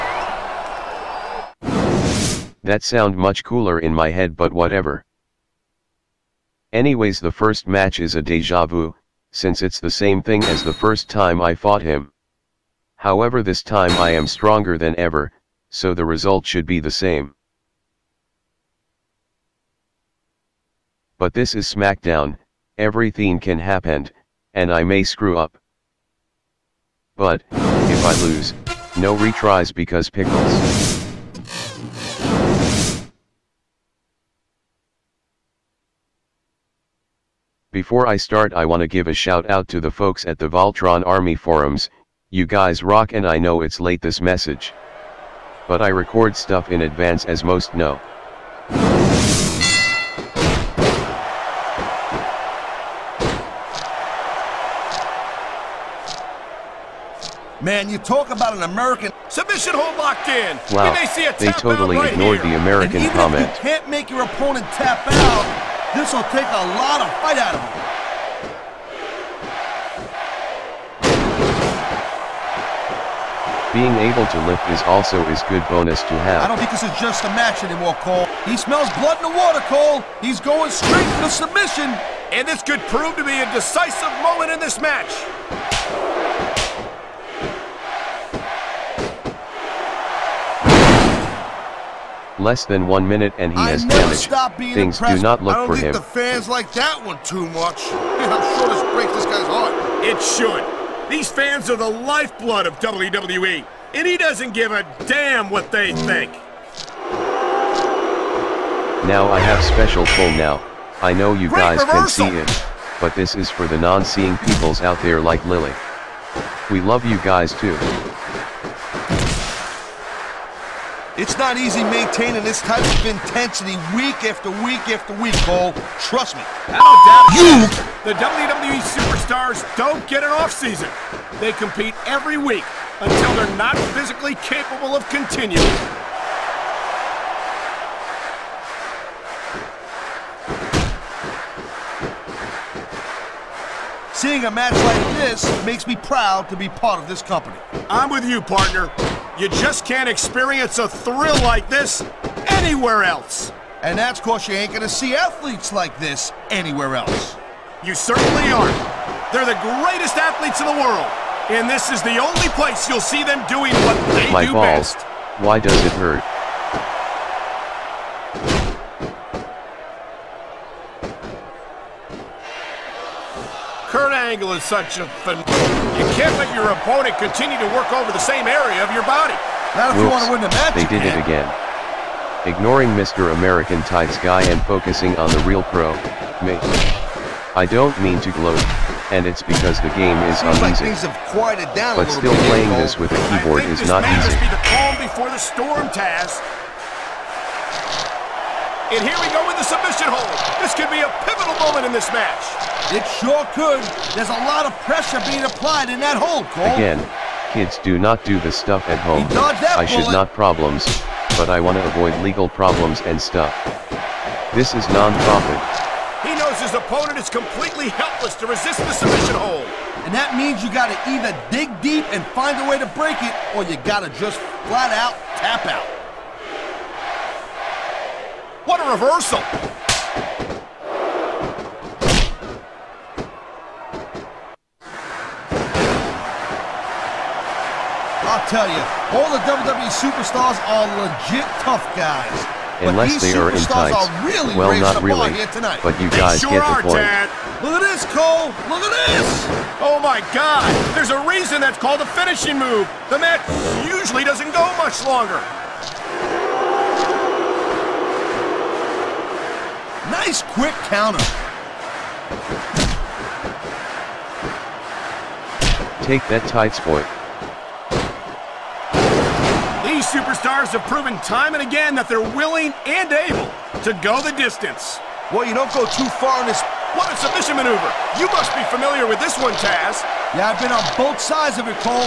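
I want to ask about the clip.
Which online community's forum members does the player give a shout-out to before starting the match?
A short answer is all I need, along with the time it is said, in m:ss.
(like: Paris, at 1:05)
Voltron Army, at 0:40.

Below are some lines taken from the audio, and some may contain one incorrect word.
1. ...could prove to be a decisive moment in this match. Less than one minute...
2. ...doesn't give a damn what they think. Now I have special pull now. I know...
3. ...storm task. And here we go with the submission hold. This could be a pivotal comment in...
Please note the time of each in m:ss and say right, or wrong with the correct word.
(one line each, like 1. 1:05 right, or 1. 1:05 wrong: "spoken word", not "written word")
1. 1:22 right
2. 1:44 right
3. 3:15 wrong: "moment", not "comment".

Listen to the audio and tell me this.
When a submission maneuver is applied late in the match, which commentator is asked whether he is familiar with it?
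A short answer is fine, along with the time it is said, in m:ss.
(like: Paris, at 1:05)
Taz, at 4:39.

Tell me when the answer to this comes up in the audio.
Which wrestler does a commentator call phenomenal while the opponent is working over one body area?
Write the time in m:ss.
2:53.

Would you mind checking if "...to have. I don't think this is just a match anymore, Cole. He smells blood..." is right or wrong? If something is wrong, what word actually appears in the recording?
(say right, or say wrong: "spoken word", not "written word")
right.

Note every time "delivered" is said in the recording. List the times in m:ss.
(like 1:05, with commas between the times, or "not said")
not said.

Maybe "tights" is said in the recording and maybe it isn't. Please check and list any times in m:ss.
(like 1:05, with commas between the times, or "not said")
3:03, 4:03, 4:26.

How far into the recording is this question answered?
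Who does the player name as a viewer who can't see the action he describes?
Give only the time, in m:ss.
1:55.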